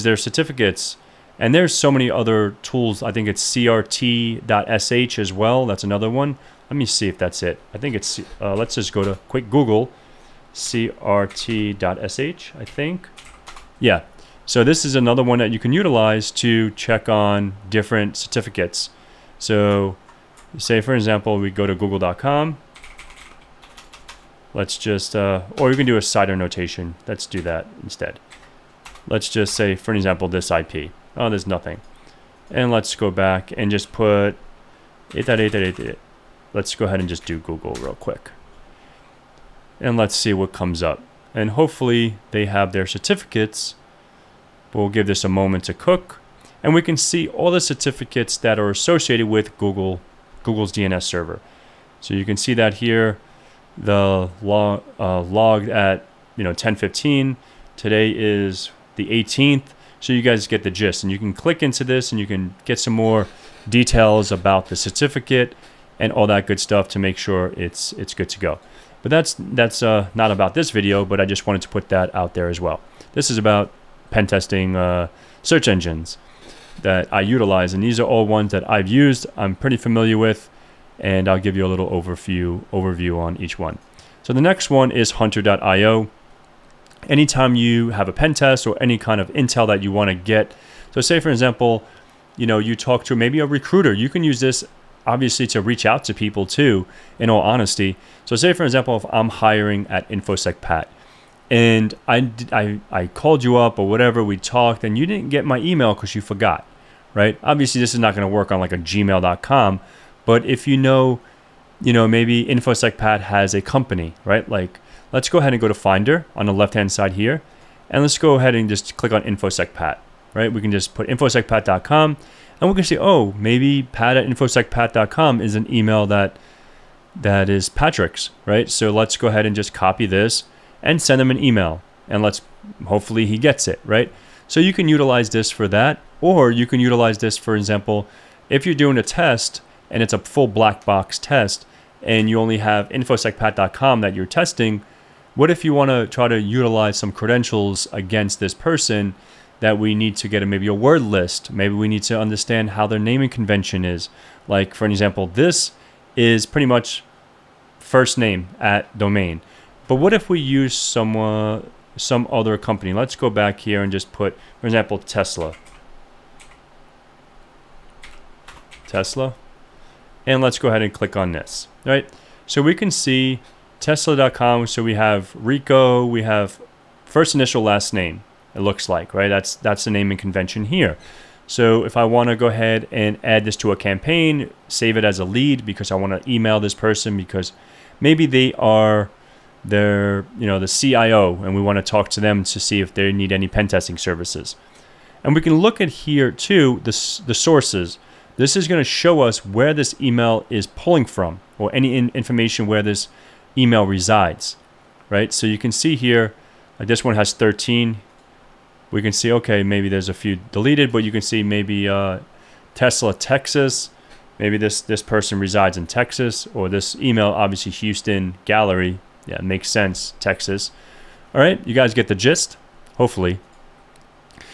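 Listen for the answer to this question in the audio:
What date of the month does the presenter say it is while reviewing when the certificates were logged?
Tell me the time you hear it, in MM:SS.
00:58.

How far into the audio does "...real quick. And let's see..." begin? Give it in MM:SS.
00:37.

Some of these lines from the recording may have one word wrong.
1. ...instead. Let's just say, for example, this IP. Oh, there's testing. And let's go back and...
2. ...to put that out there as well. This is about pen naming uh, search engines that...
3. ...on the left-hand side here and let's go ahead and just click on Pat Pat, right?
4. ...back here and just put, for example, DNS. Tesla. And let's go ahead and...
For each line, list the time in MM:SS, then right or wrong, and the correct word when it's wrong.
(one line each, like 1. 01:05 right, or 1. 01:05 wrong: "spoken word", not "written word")
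1. 00:27 wrong: "nothing", not "testing"
2. 01:11 wrong: "testing", not "naming"
3. 01:56 wrong: "InfoSec", not "Pat"
4. 02:43 wrong: "Tesla", not "DNS".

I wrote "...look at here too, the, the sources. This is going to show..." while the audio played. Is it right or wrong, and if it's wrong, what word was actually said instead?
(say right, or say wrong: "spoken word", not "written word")
right.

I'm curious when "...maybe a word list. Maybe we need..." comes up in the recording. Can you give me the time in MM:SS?
02:30.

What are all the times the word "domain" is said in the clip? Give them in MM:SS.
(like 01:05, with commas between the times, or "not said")
02:38.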